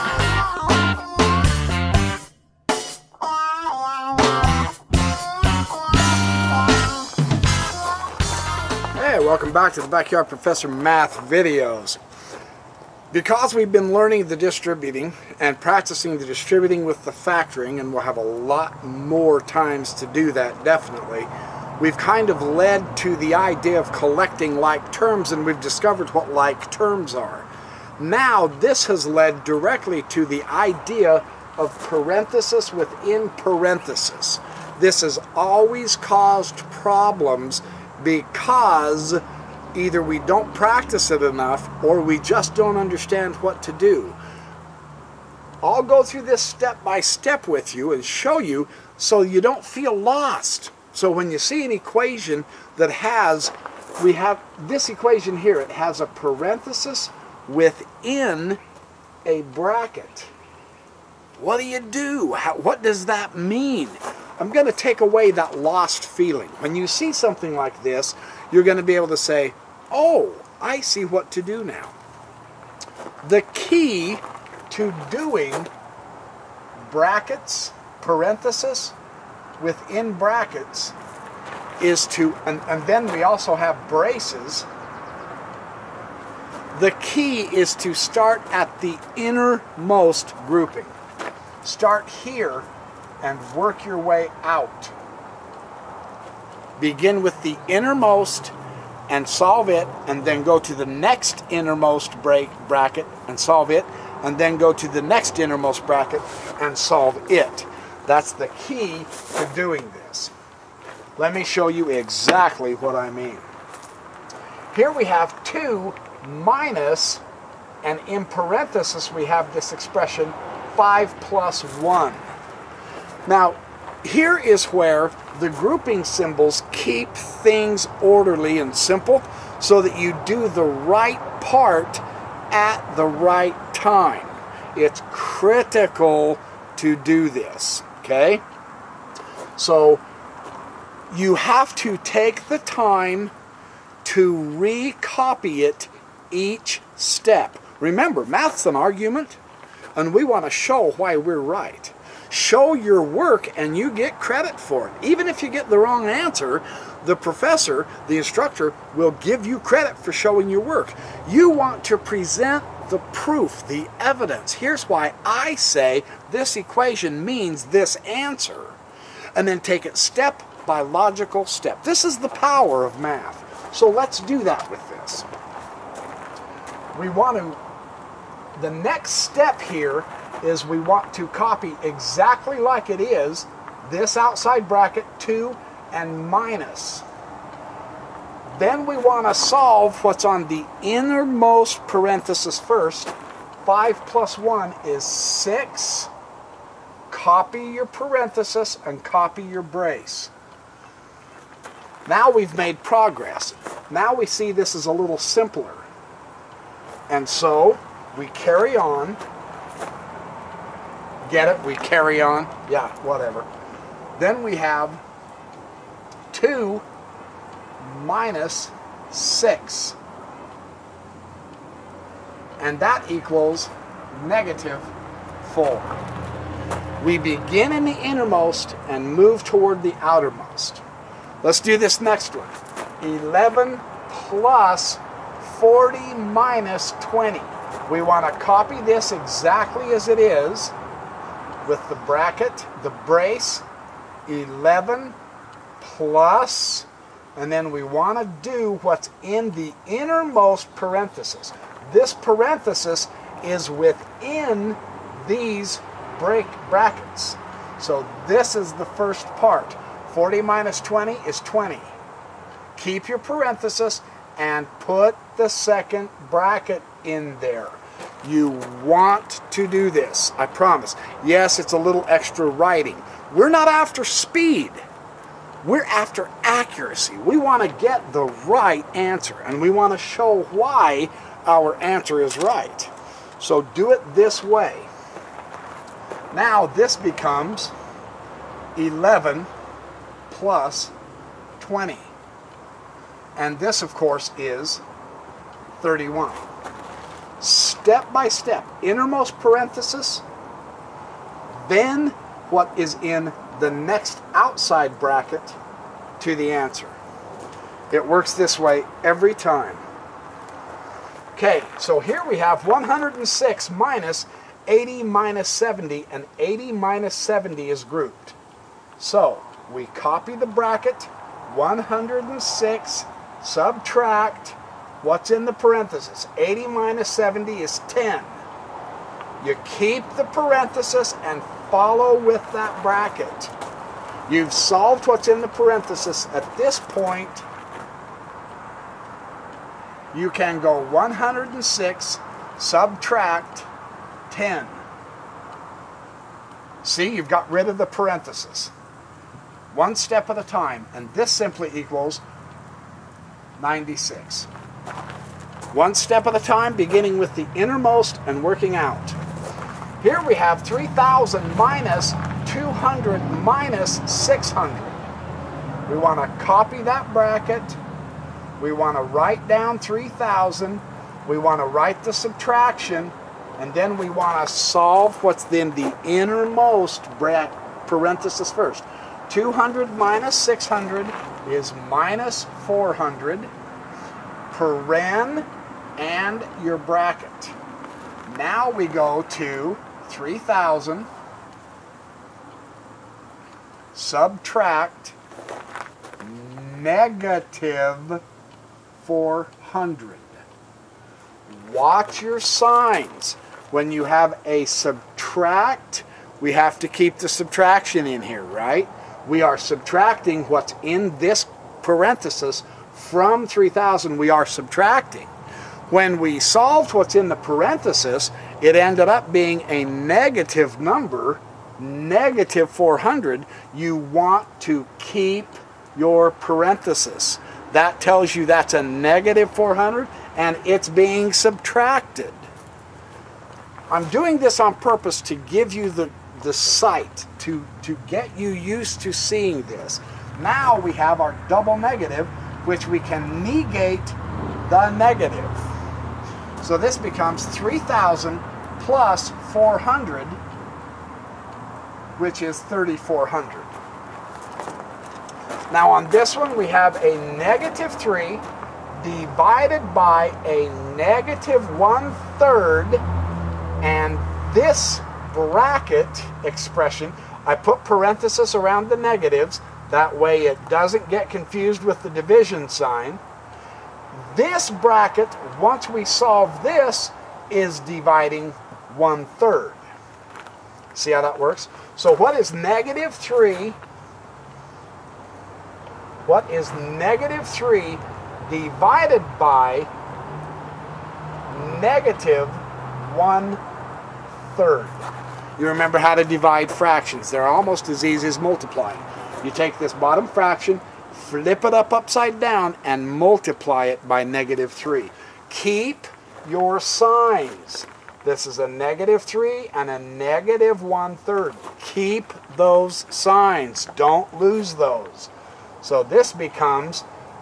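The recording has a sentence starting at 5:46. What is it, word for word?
See, you've got rid of the parenthesis.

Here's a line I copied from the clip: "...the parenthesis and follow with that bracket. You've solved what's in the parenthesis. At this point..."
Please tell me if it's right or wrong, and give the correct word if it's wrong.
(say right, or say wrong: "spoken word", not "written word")
right.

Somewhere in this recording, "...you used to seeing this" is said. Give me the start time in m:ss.
7:18.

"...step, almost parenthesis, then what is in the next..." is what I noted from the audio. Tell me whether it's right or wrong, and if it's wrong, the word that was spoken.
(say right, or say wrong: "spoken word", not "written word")
wrong: "innermost", not "almost".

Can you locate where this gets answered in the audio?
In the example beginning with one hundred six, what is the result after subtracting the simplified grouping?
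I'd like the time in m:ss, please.
5:53.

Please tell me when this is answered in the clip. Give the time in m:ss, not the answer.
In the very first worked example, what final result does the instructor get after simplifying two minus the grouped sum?
3:44.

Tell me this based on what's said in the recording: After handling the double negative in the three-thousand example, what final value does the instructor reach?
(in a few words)
3,400.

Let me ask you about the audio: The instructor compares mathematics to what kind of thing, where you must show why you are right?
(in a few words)
an argument.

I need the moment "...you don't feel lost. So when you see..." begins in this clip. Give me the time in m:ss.
0:49.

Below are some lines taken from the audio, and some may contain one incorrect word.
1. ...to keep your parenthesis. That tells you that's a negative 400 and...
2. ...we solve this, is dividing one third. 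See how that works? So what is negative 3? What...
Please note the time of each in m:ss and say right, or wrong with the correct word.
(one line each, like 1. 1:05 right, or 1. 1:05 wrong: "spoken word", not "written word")
1. 7:04 right
2. 7:55 right.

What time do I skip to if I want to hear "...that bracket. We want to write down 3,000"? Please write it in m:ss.
6:06.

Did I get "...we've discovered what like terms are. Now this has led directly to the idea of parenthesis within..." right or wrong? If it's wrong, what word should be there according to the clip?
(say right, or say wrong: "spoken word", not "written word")
right.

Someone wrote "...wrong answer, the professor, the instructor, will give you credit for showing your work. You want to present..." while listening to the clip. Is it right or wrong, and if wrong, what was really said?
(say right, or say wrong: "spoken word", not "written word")
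right.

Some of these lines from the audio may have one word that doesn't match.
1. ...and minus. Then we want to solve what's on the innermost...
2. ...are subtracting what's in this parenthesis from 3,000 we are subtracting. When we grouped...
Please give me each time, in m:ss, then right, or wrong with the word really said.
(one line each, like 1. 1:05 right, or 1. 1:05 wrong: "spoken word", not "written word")
1. 3:05 right
2. 6:49 wrong: "solved", not "grouped".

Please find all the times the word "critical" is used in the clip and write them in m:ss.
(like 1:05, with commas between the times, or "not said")
2:15.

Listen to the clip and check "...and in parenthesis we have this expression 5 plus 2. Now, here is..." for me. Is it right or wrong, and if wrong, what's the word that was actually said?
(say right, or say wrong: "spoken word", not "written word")
wrong: "1", not "2".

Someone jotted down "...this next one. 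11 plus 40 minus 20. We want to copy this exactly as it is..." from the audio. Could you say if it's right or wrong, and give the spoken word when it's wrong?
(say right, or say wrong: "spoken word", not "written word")
right.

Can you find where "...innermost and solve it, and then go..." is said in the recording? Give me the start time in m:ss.
1:37.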